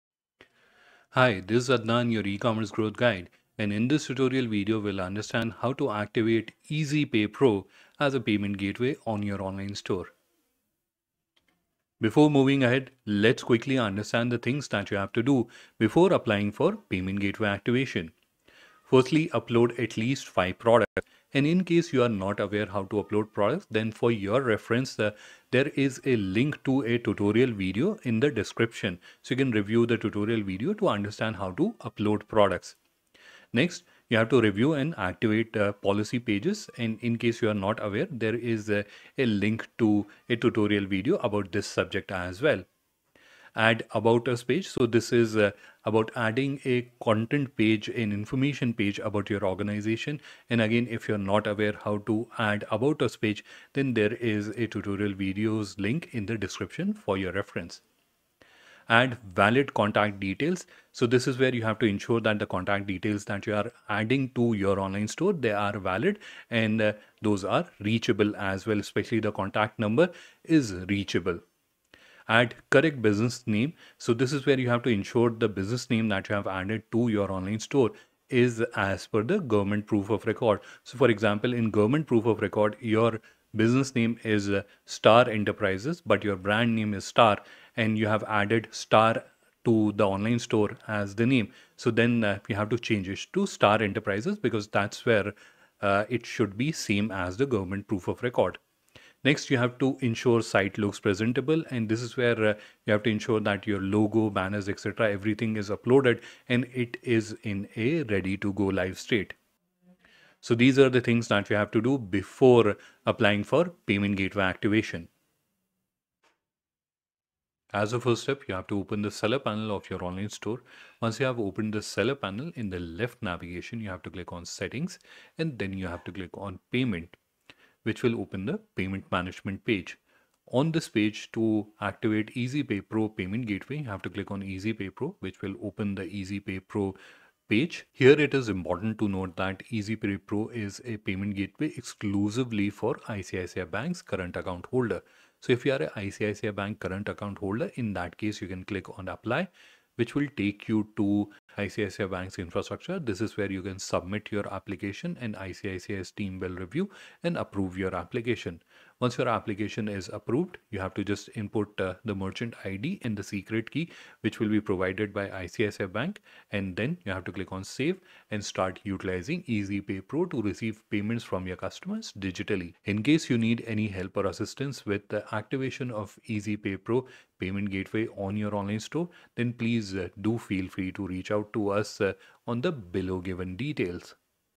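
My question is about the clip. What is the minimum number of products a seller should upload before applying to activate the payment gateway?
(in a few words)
5.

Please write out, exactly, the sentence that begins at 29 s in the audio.
So you can review the tutorial video to understand how to upload products.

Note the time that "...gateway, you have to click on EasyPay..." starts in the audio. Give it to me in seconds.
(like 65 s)
133 s.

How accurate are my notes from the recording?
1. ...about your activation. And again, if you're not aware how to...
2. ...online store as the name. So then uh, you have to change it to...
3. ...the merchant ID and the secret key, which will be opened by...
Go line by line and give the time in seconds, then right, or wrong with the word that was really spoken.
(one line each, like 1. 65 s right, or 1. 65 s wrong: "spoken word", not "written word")
1. 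48 s wrong: "organization", not "activation"
2. 90 s right
3. 162 s wrong: "provided", not "opened".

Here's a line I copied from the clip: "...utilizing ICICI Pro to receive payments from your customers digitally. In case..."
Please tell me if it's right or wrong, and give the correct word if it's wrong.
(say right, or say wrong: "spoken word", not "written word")
wrong: "EasyPay", not "ICICI".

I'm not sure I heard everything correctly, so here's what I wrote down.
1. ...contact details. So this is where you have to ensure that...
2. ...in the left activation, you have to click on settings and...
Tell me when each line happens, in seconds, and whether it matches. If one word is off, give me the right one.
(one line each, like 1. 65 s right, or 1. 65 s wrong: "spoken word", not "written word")
1. 59 s right
2. 122 s wrong: "navigation", not "activation".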